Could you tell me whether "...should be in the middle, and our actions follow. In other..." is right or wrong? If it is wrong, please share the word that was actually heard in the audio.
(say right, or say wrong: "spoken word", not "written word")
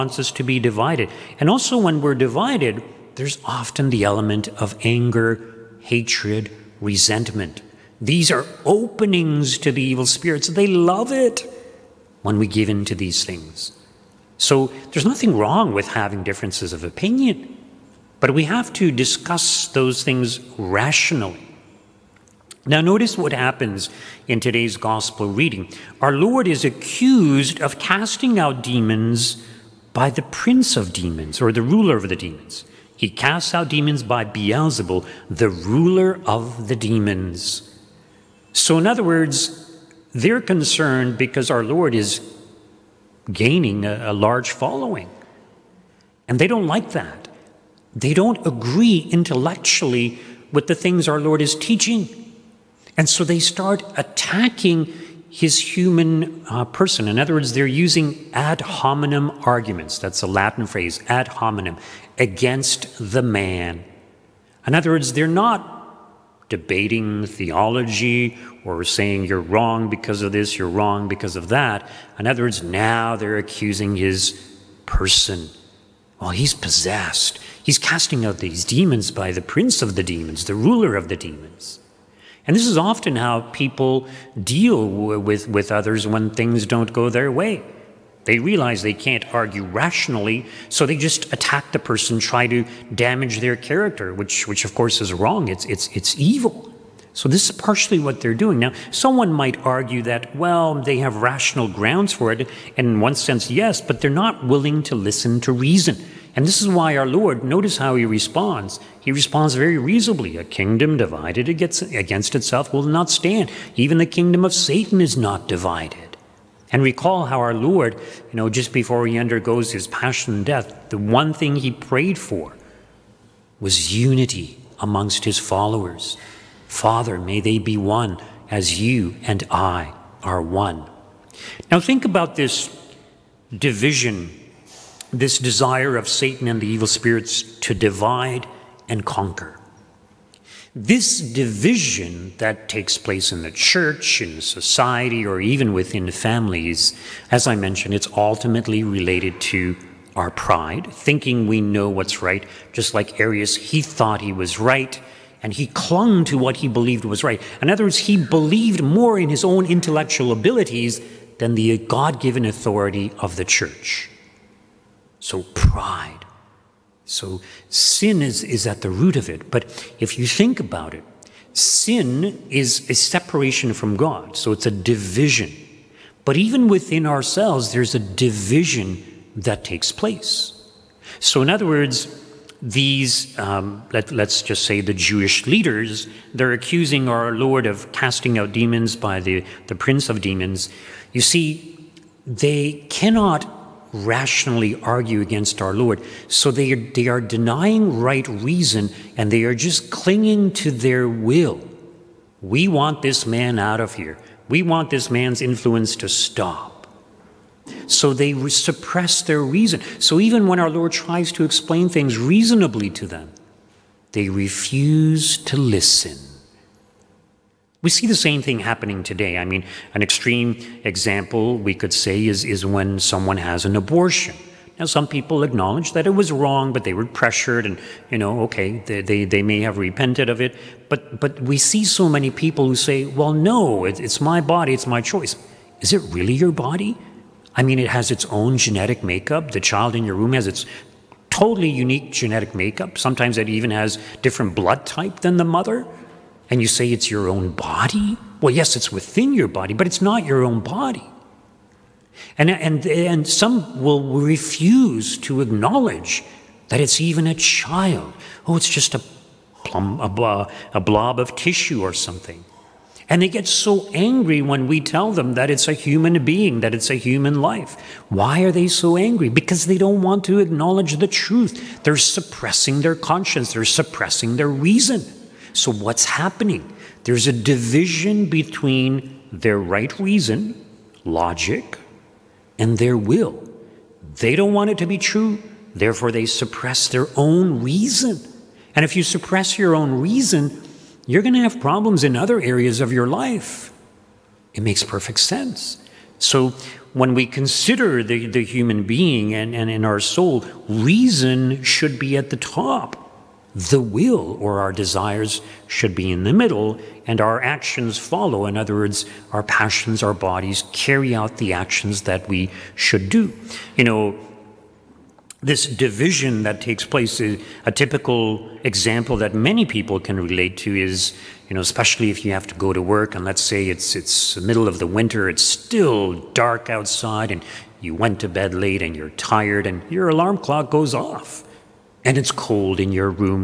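right.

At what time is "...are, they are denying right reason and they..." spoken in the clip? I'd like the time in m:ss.
3:16.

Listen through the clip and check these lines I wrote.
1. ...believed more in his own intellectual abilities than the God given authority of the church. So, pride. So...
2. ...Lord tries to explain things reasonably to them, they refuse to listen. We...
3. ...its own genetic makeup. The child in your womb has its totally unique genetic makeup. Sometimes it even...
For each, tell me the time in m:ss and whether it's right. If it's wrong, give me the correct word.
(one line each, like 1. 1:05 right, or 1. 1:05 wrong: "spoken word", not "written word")
1. 2:38 right
2. 3:30 right
3. 3:58 right.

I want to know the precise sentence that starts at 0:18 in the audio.
But we have to discuss those things rationally.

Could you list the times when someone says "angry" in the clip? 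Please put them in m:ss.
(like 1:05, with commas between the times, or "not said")
4:23, 4:28.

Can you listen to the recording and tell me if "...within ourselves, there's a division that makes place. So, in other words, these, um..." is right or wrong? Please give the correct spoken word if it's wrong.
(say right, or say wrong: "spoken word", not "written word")
wrong: "takes", not "makes".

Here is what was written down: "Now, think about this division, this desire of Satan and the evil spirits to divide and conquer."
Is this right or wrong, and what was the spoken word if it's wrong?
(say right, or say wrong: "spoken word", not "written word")
right.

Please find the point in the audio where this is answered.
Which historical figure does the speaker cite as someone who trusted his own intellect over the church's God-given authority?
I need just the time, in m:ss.
2:33.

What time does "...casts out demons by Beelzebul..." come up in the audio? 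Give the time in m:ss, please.
0:33.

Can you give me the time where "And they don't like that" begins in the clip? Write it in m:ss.
0:46.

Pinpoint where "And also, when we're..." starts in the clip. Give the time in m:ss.
0:01.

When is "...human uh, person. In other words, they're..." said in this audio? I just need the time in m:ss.
0:55.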